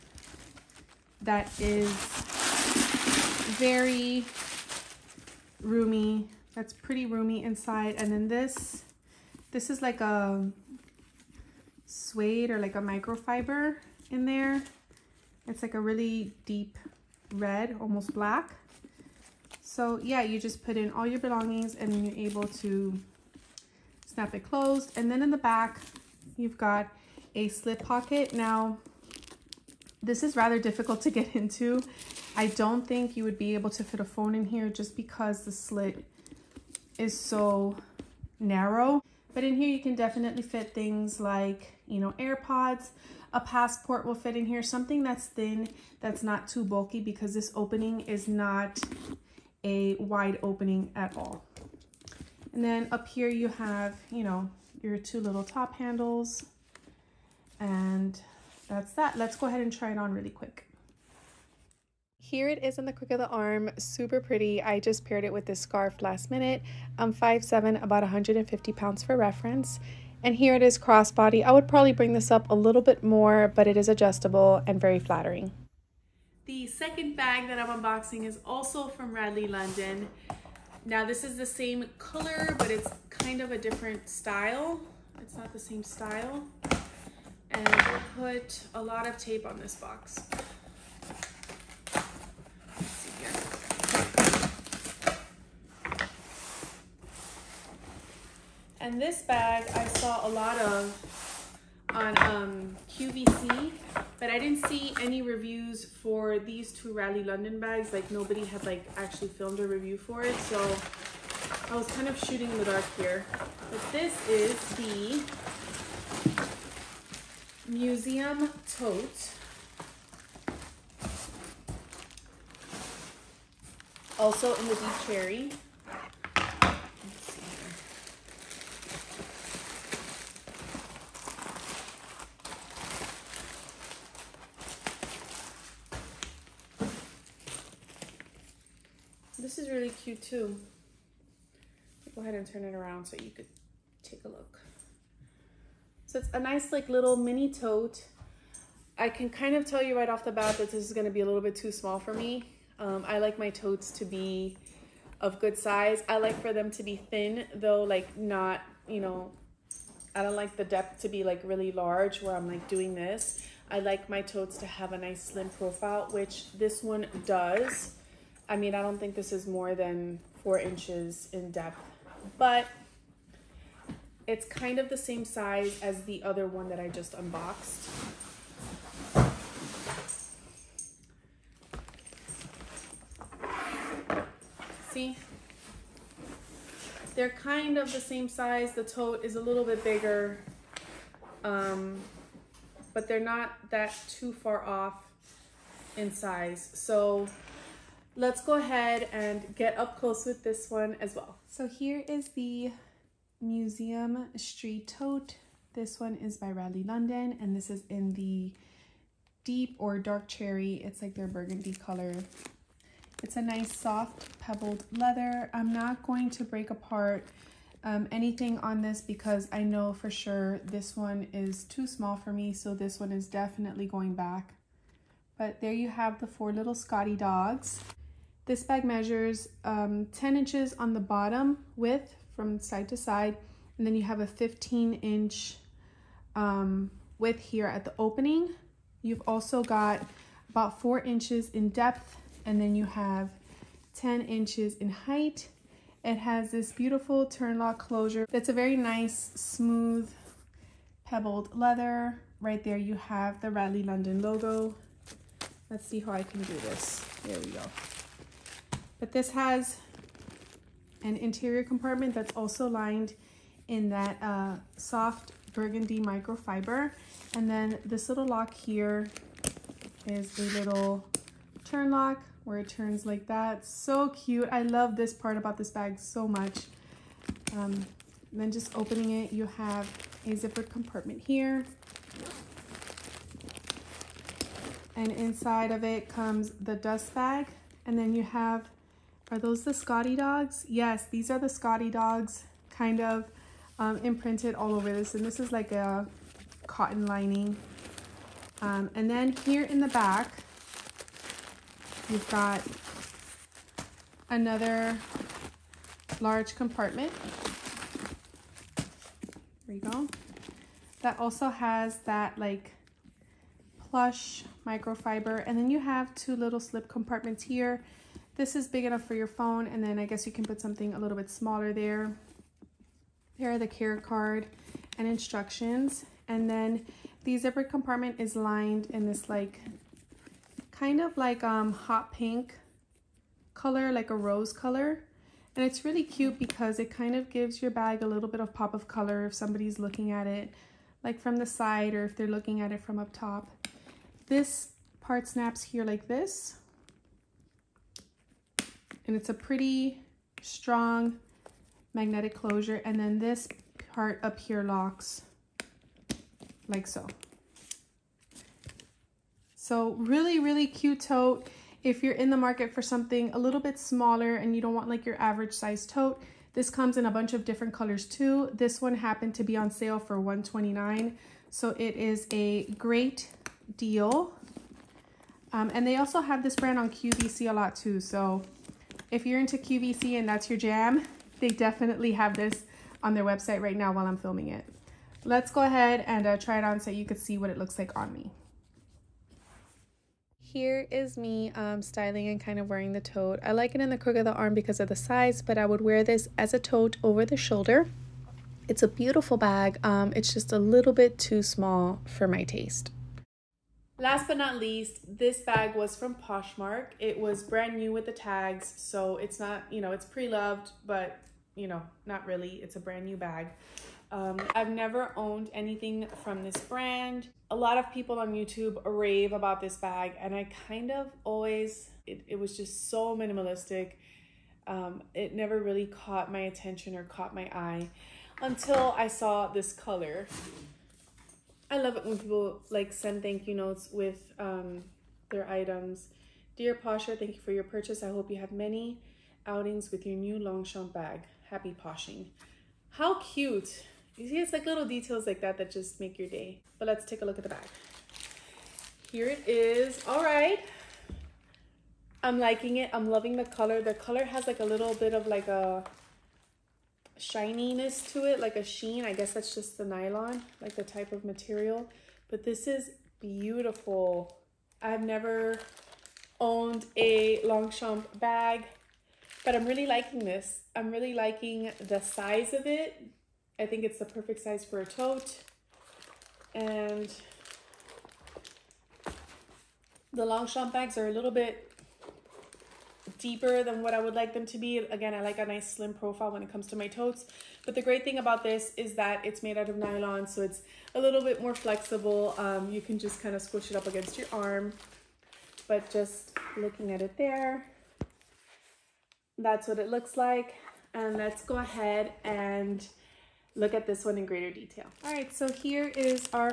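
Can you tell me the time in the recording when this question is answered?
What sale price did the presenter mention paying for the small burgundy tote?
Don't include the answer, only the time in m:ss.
6:10.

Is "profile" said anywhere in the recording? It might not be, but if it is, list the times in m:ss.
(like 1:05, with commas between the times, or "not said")
2:45, 8:05.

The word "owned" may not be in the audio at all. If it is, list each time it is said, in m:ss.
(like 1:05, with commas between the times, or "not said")
6:55, 7:46.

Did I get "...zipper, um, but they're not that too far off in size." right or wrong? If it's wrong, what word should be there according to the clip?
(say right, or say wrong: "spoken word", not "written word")
wrong: "bigger", not "zipper".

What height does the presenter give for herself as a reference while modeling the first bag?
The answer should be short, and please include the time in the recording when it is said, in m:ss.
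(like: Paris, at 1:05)
5'7", at 1:07.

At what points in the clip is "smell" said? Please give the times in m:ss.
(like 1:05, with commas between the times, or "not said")
not said.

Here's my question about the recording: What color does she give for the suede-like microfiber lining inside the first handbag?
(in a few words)
deep red, almost black.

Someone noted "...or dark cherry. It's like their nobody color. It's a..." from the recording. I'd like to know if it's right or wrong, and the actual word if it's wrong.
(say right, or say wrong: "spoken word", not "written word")
wrong: "burgundy", not "nobody".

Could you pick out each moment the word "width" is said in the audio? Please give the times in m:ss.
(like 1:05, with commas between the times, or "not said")
3:51, 3:57.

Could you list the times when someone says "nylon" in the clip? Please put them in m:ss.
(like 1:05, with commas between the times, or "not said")
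7:39, 8:09.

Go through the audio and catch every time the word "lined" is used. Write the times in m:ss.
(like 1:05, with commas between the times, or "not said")
4:22, 5:28.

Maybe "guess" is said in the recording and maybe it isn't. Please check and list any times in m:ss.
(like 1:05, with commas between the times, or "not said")
5:20, 7:39.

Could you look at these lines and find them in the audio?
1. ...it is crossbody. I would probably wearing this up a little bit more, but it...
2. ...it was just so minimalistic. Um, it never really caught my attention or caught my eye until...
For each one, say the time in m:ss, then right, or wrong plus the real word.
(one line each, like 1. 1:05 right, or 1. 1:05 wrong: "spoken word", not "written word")
1. 1:10 wrong: "bring", not "wearing"
2. 7:02 right.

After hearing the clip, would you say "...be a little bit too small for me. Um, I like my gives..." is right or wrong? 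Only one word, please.
wrong.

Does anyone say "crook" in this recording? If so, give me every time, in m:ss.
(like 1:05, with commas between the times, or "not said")
1:02, 6:33.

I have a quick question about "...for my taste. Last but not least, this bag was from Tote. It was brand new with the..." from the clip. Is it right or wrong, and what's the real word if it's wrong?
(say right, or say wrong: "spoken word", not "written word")
wrong: "Poshmark", not "Tote".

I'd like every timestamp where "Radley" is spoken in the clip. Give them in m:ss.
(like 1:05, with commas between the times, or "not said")
1:19, 1:46, 3:26, 4:13.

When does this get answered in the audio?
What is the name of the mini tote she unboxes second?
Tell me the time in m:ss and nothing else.
1:57.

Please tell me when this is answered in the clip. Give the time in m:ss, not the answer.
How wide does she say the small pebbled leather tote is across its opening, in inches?
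3:54.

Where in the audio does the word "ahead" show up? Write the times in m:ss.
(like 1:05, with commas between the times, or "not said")
0:59, 2:22, 3:18, 6:25, 8:21.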